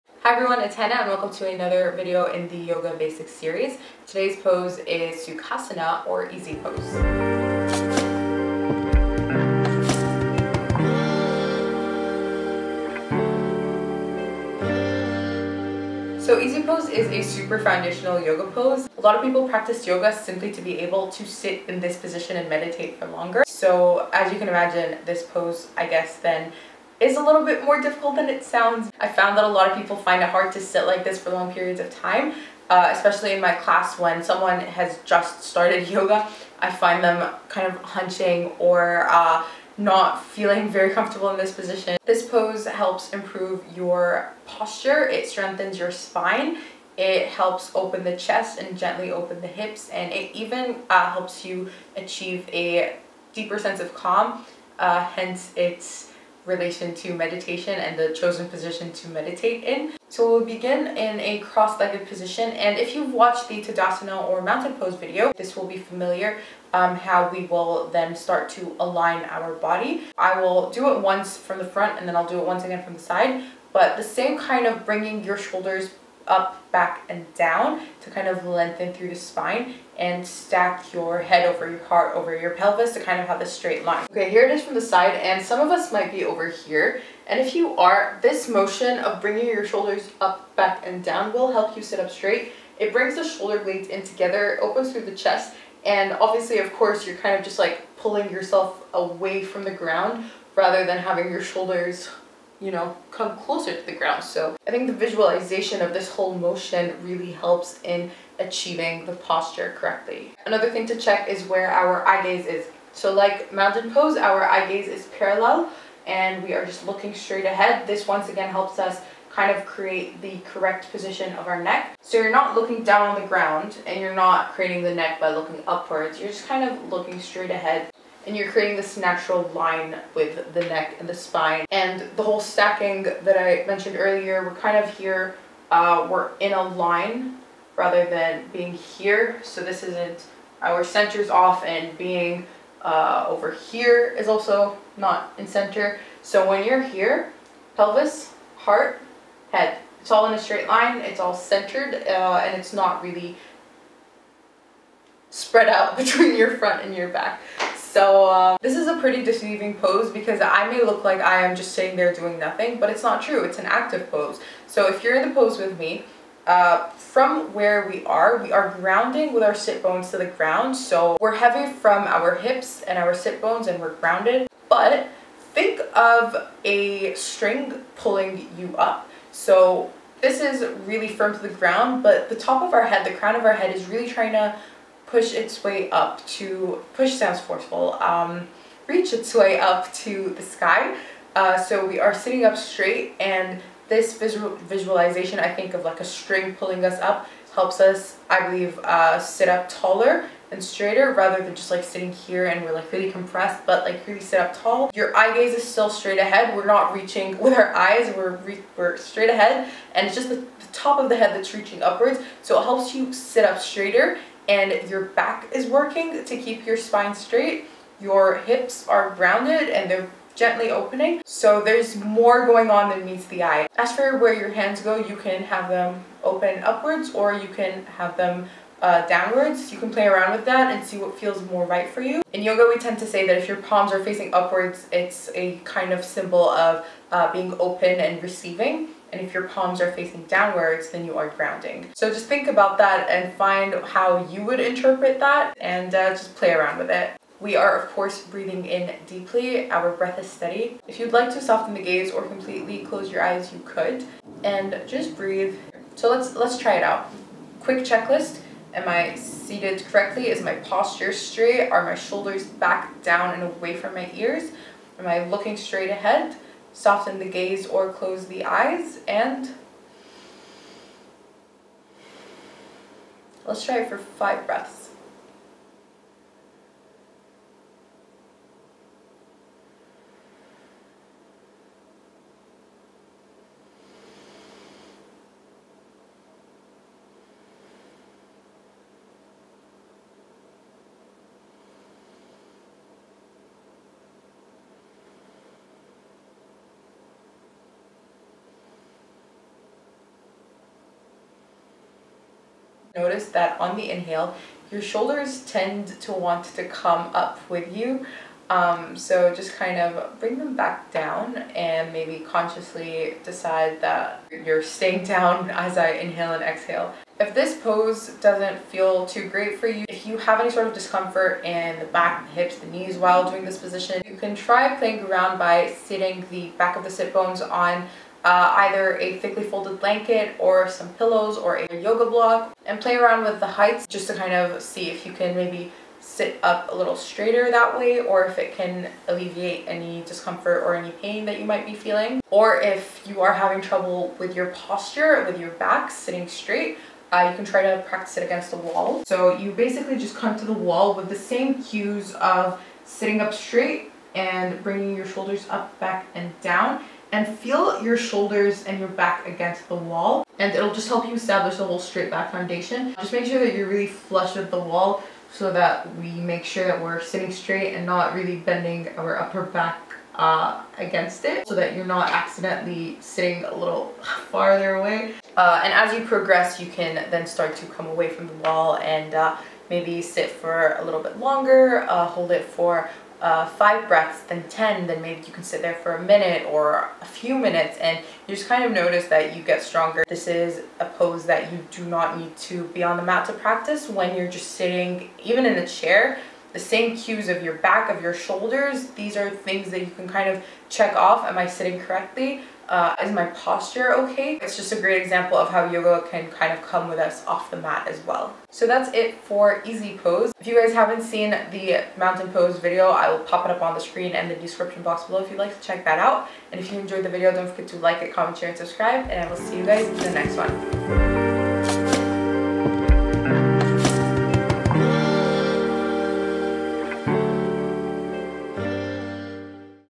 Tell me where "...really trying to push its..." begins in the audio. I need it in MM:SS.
03:03.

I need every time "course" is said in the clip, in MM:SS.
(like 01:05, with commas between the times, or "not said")
01:36, 04:07.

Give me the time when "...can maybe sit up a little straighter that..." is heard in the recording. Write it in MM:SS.
05:35.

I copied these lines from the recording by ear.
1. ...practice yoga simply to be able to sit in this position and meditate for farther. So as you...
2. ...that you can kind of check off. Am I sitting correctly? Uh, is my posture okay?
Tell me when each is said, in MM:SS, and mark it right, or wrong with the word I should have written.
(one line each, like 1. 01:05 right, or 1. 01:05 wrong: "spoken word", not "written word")
1. 00:19 wrong: "longer", not "farther"
2. 06:39 right.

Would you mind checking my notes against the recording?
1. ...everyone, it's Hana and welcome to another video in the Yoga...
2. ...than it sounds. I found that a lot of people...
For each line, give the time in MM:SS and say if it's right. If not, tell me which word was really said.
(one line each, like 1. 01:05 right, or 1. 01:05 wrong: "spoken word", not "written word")
1. 00:00 right
2. 00:28 right.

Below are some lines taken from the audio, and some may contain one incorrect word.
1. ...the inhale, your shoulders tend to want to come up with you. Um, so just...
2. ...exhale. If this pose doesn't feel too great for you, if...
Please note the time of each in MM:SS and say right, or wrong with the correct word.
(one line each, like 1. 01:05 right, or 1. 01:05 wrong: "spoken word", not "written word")
1. 05:03 right
2. 05:16 right.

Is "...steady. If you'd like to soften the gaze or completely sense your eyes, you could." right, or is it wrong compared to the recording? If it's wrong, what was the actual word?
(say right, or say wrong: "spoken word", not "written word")
wrong: "close", not "sense".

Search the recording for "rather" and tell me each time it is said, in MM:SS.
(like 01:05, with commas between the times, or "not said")
01:40, 02:17, 03:21.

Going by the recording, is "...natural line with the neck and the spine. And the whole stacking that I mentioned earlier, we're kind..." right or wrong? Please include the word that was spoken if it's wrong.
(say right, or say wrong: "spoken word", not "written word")
right.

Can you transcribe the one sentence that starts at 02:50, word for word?
So we're heavy from our hips and our sit bones and we're grounded.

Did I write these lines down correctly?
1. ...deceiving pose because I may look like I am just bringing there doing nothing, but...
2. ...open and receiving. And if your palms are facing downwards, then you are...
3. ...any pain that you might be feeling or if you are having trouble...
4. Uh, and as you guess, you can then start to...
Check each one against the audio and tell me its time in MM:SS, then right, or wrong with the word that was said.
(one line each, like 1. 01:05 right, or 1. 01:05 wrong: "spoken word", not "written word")
1. 02:39 wrong: "sitting", not "bringing"
2. 03:57 right
3. 05:40 right
4. 06:15 wrong: "progress", not "guess".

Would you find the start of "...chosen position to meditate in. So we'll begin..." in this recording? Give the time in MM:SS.
00:58.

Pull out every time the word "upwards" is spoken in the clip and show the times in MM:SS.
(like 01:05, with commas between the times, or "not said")
02:05, 03:31, 03:46, 03:54.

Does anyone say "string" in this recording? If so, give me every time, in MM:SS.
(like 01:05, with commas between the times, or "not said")
02:57, 03:16.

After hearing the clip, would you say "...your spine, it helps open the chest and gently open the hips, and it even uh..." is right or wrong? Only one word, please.
right.